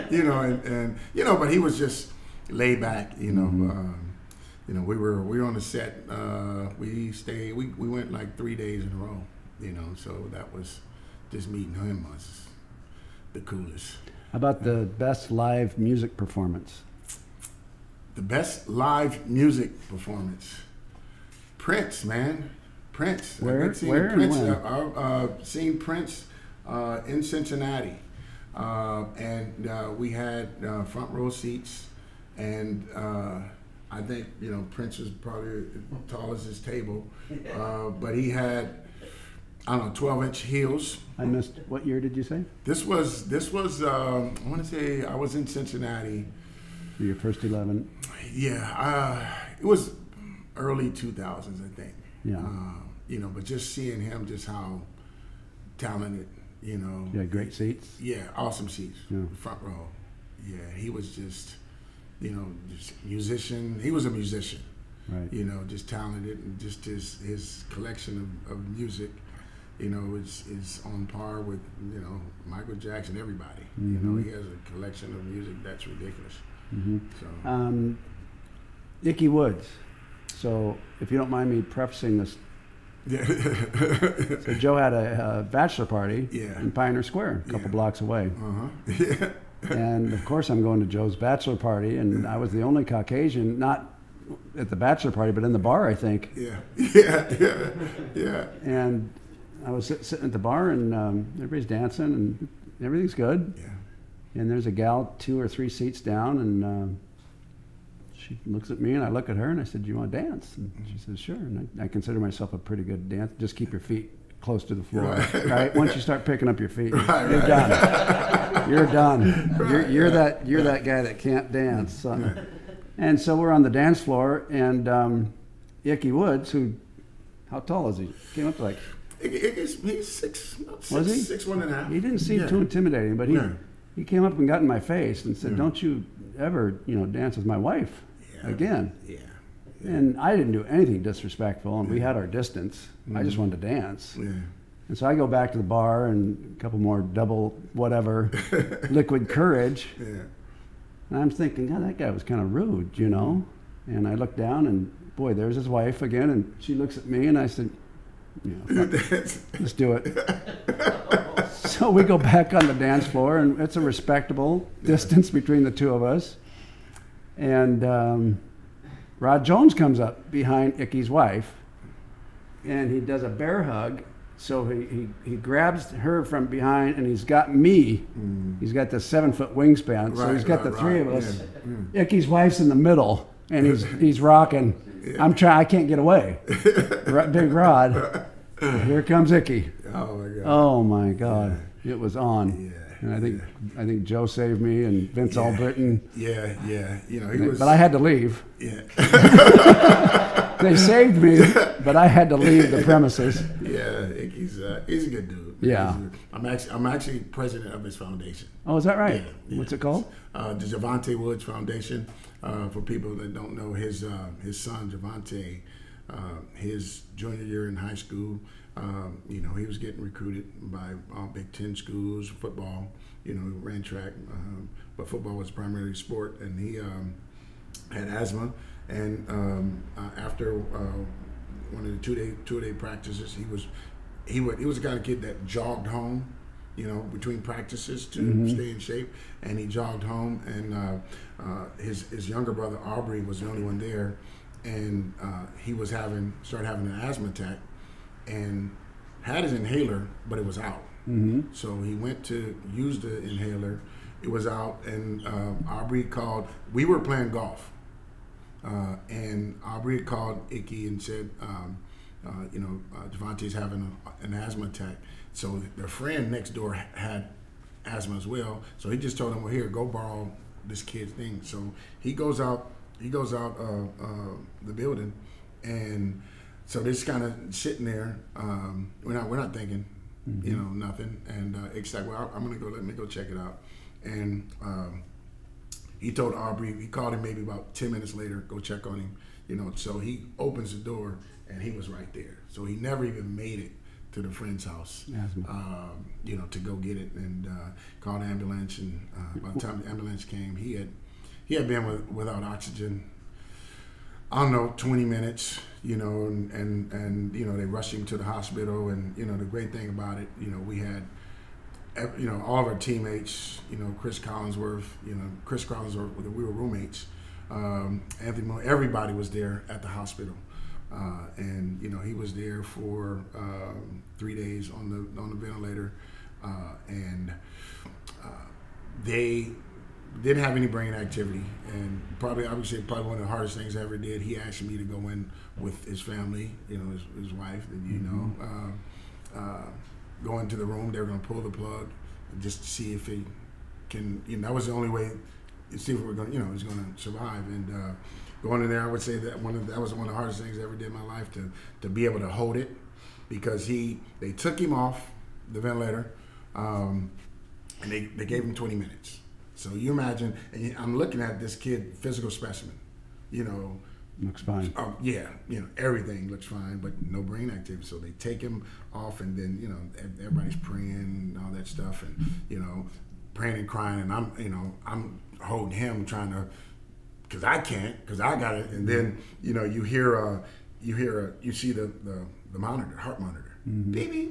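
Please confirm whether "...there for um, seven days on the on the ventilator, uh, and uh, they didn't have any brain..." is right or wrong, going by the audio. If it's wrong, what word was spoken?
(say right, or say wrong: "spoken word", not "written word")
wrong: "three", not "seven".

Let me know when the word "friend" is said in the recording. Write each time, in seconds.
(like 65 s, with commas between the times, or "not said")
265 s, 294 s.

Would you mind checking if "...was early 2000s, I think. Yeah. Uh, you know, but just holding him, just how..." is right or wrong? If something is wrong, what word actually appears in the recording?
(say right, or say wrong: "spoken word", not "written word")
wrong: "seeing", not "holding".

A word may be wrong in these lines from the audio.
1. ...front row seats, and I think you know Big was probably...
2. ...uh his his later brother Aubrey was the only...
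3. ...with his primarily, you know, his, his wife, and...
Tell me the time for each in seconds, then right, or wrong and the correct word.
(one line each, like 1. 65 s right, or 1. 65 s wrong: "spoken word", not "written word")
1. 30 s wrong: "Prince", not "Big"
2. 241 s wrong: "younger", not "later"
3. 335 s wrong: "family", not "primarily".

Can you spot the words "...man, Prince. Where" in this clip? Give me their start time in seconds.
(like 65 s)
22 s.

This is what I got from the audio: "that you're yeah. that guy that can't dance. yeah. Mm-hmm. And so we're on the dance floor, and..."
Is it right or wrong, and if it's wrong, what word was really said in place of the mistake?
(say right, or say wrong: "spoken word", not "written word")
right.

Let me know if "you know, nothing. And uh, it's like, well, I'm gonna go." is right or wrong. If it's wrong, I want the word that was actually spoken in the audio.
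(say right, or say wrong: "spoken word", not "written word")
right.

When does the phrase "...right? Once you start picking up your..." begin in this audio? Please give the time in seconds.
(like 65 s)
115 s.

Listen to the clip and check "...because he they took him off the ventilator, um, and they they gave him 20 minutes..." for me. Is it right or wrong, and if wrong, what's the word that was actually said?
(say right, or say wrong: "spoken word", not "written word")
right.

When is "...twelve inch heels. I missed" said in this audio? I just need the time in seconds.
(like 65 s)
39 s.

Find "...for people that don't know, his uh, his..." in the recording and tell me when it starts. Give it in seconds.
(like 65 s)
212 s.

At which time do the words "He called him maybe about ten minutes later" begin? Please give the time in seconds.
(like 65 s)
286 s.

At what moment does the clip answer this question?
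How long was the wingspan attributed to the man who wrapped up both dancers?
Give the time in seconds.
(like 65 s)
178 s.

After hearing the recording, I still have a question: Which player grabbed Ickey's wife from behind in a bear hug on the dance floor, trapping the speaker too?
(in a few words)
Rod Jones.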